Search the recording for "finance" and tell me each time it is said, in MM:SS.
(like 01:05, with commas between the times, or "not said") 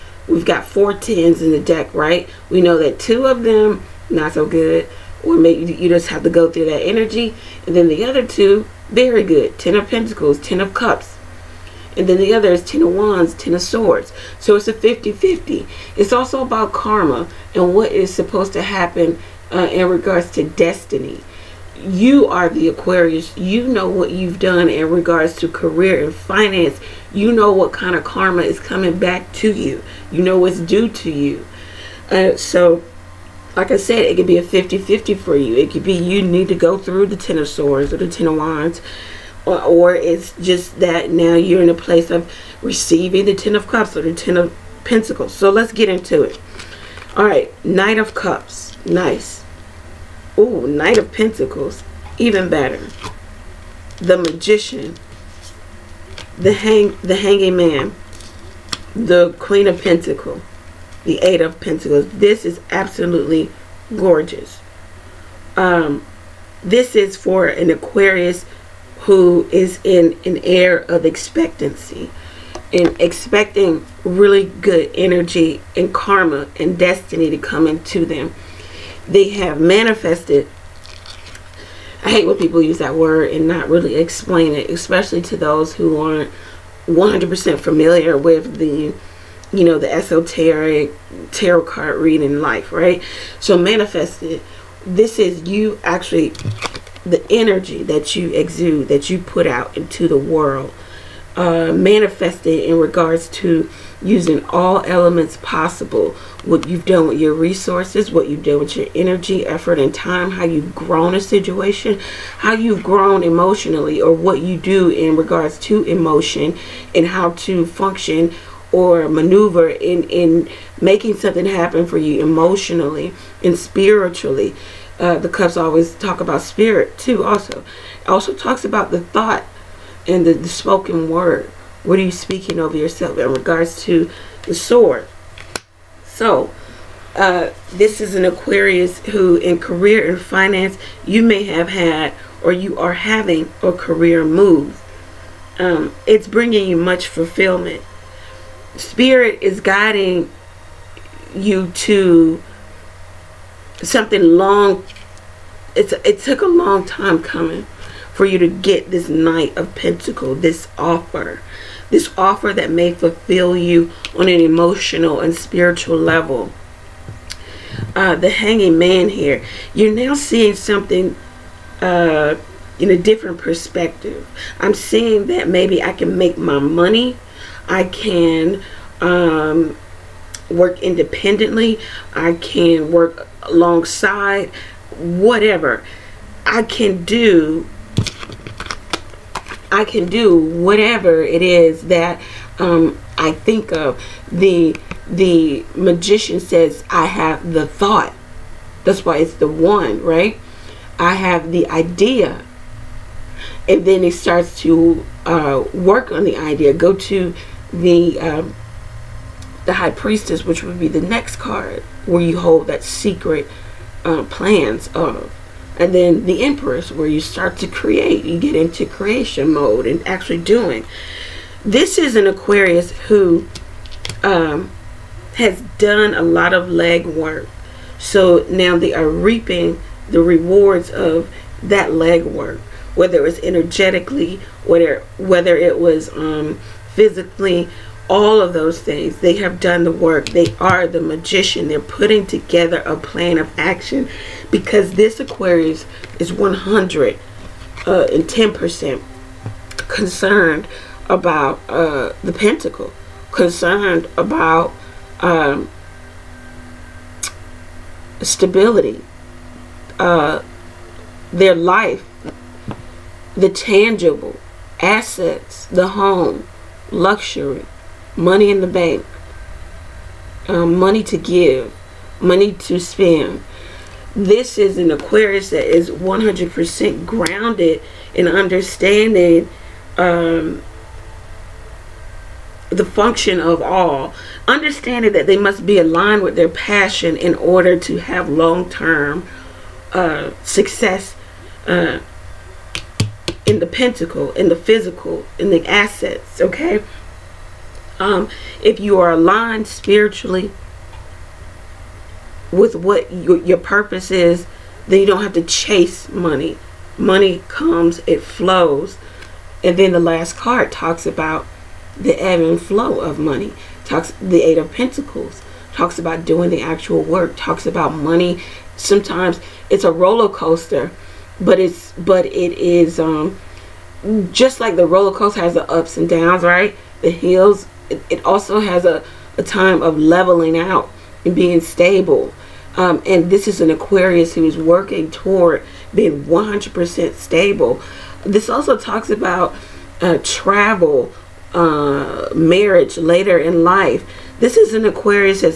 00:26, 02:20.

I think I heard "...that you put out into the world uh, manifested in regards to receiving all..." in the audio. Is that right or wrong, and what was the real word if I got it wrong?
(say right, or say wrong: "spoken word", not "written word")
wrong: "using", not "receiving".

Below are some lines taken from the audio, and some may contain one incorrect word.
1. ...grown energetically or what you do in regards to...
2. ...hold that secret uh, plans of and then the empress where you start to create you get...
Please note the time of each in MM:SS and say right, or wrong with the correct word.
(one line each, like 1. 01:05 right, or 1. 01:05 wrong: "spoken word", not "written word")
1. 01:52 wrong: "emotionally", not "energetically"
2. 03:32 right.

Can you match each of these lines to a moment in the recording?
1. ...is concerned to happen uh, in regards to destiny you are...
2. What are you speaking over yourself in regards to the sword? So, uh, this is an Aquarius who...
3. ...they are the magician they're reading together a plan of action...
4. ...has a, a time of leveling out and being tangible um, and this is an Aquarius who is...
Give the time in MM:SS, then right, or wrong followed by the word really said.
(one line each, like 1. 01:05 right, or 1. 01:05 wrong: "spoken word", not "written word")
1. 00:17 wrong: "supposed", not "concerned"
2. 02:11 right
3. 04:00 wrong: "putting", not "reading"
4. 05:28 wrong: "stable", not "tangible".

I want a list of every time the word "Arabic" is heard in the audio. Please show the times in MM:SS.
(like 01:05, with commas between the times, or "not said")
not said.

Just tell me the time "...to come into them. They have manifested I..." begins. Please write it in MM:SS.
01:17.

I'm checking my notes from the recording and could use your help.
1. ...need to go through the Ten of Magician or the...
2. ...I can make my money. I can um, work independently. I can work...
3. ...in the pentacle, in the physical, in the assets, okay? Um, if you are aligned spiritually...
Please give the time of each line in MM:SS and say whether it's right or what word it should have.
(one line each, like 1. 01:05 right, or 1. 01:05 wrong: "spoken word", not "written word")
1. 00:36 wrong: "Swords", not "Magician"
2. 02:55 right
3. 04:53 right.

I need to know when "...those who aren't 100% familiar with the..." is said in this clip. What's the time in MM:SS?
01:25.